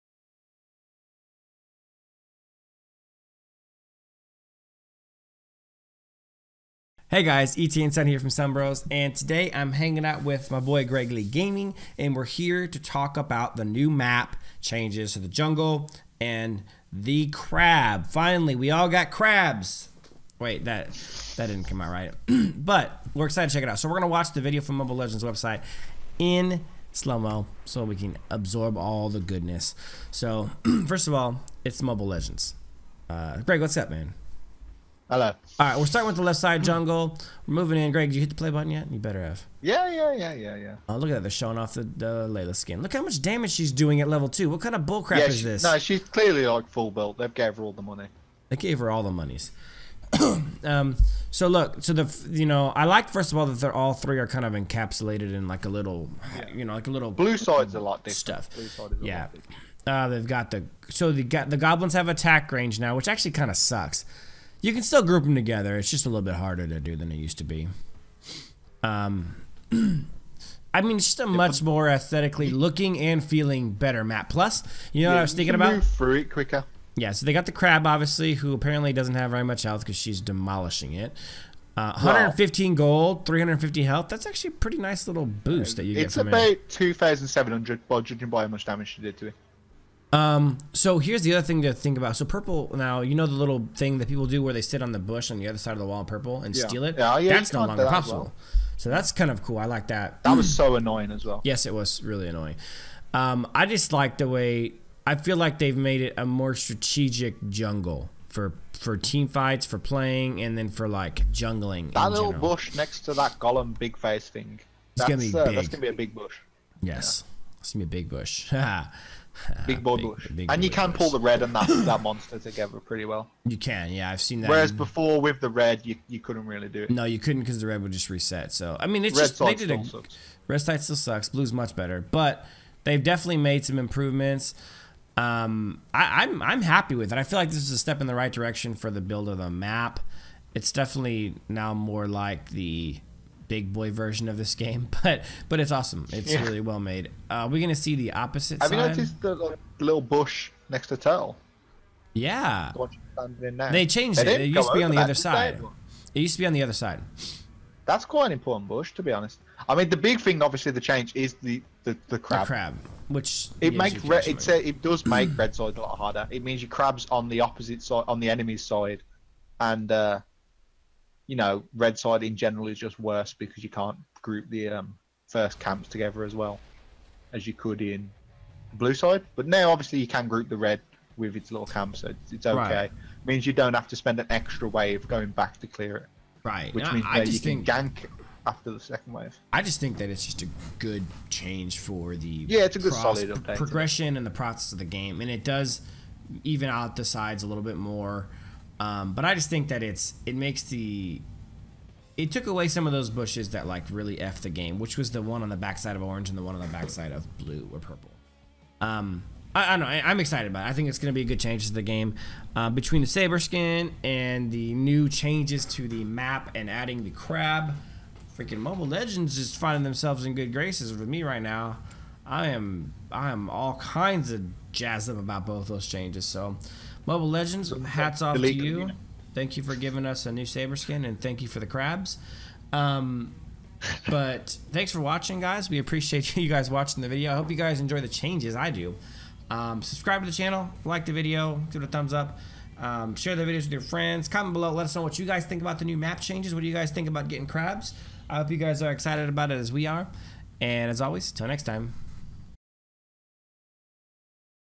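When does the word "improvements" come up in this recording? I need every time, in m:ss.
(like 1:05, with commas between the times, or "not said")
2:13.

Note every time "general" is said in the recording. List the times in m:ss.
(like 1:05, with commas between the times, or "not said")
1:52, 2:52.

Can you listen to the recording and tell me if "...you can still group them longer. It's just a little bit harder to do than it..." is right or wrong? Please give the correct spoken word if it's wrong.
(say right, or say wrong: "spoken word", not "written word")
wrong: "together", not "longer".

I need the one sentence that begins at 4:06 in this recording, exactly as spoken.
What do you guys think about getting crabs?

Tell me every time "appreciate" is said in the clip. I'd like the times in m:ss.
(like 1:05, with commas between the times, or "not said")
3:55.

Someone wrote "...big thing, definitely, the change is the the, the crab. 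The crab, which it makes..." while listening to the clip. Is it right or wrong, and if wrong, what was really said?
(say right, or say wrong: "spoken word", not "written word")
wrong: "obviously", not "definitely".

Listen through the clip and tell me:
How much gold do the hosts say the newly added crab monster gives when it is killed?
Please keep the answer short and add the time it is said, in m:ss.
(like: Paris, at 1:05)
115, at 1:21.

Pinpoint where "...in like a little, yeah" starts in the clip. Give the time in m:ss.
0:55.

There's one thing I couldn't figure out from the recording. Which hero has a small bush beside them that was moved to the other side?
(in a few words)
Tell.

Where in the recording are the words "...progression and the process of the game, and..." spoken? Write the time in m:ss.
3:13.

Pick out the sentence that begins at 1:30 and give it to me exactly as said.
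Um, so here's the other thing to think about.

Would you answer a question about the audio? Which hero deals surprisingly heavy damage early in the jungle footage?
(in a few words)
Layla.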